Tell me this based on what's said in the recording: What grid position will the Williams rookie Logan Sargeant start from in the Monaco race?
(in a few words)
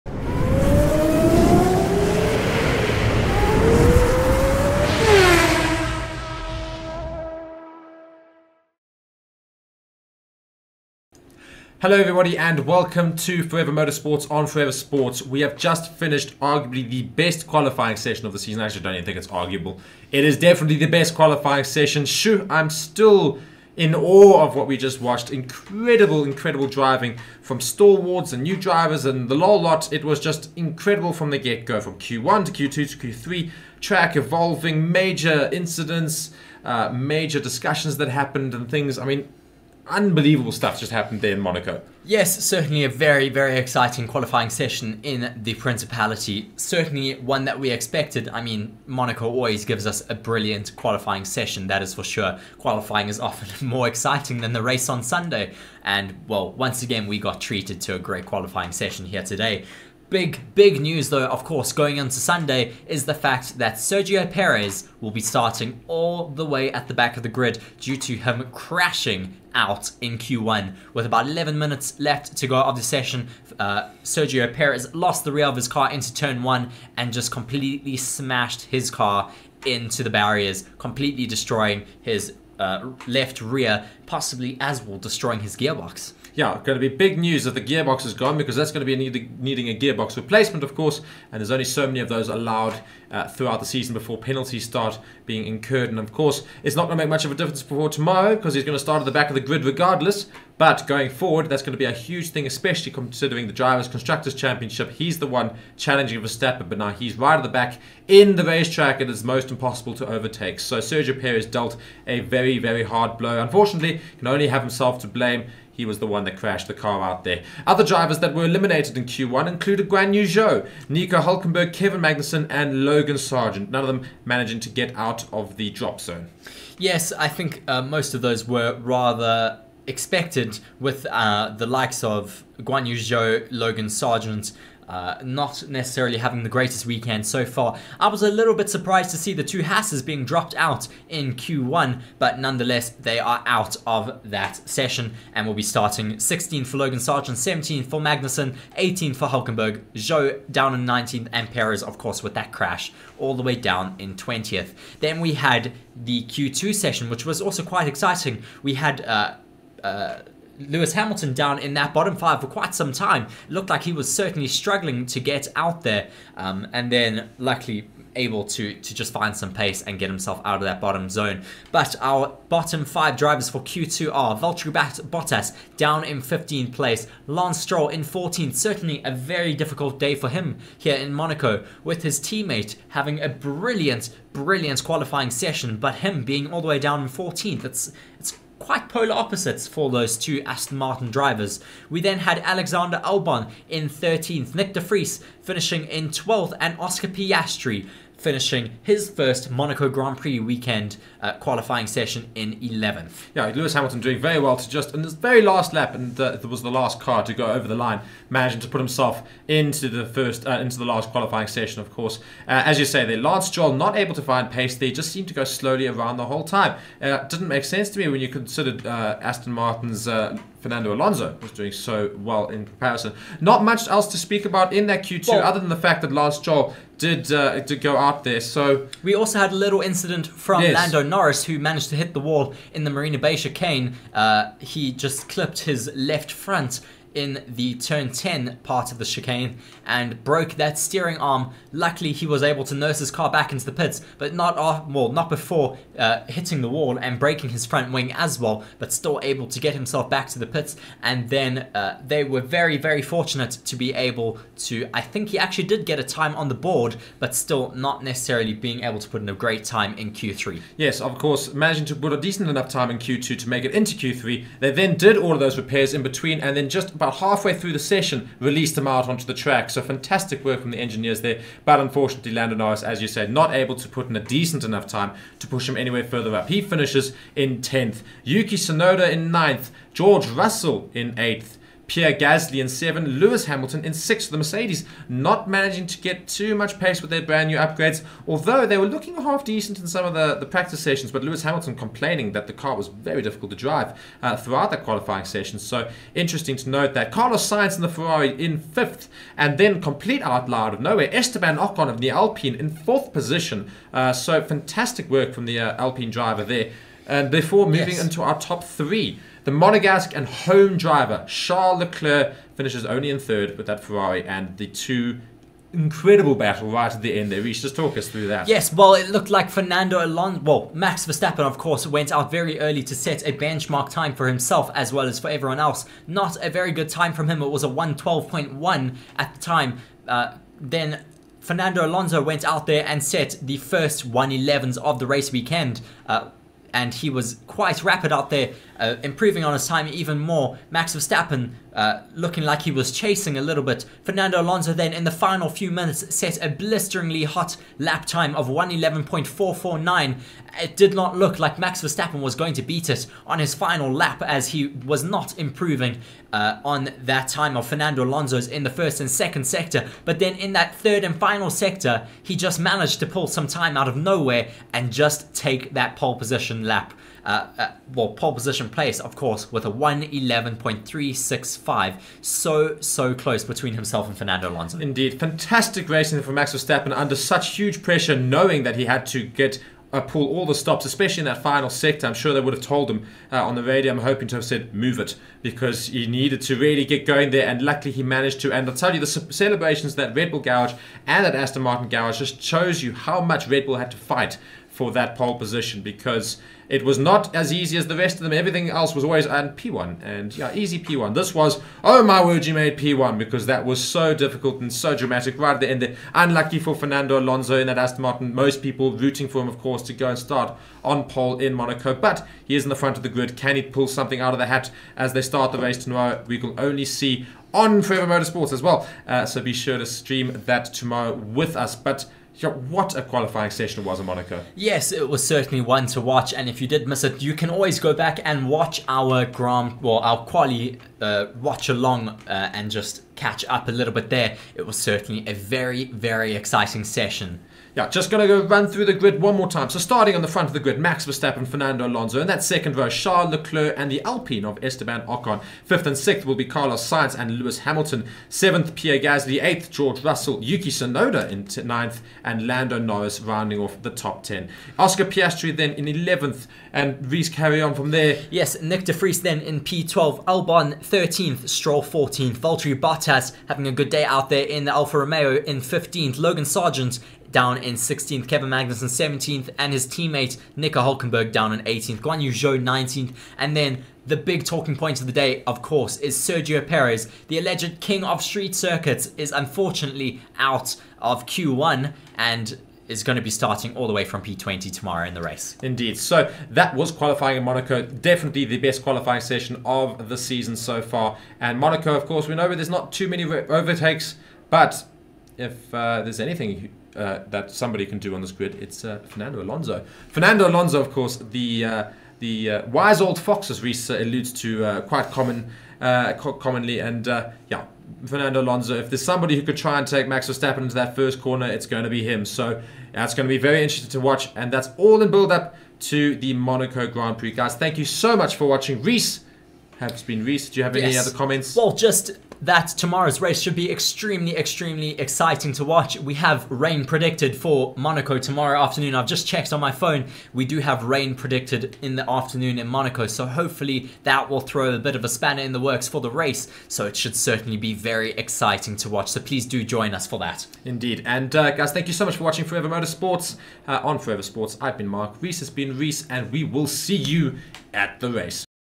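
16.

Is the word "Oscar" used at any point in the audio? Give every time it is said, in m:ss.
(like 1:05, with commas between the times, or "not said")
3:16, 7:34.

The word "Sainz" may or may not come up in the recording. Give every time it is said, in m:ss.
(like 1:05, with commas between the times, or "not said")
4:57, 7:26.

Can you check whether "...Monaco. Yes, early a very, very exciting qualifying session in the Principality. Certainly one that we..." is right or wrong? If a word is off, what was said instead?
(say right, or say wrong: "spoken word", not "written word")
wrong: "certainly", not "early".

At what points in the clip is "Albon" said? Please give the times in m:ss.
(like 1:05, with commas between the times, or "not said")
3:13, 7:40.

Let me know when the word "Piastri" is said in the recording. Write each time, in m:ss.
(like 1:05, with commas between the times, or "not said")
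3:17, 7:35.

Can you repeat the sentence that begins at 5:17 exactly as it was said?
Reese, just talk us through that.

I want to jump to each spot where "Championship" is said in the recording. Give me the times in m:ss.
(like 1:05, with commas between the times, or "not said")
1:44.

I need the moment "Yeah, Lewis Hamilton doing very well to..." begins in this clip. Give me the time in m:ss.
3:23.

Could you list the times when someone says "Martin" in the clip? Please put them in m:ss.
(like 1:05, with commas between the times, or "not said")
3:10, 3:39, 6:31, 6:48.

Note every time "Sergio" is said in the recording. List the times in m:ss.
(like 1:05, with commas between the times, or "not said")
1:03, 1:14, 1:50, 7:56.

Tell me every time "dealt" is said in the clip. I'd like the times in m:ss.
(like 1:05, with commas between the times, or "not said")
1:51.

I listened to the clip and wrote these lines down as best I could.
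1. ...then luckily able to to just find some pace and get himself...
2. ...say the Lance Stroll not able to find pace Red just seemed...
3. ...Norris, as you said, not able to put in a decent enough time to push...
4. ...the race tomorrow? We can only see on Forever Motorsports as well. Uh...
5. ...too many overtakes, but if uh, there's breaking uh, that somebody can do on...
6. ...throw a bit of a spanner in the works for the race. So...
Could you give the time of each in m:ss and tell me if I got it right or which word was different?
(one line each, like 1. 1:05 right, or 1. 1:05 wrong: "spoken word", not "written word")
1. 2:46 right
2. 3:32 wrong: "They", not "Red"
3. 4:32 right
4. 6:55 right
5. 8:12 wrong: "anything", not "breaking"
6. 8:54 right.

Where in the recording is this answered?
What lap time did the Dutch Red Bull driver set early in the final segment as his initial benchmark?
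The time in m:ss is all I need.
5:27.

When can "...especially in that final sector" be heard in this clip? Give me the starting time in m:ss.
6:20.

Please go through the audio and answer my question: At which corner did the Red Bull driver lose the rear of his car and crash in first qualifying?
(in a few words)
Turn one.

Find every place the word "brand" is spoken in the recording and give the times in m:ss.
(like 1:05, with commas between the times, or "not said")
4:47.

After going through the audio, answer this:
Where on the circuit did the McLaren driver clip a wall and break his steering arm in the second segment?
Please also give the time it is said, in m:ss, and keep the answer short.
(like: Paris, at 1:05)
Marina Bay chicane, at 3:52.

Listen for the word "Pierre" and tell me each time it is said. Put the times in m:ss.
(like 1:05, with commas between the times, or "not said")
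4:41, 7:28.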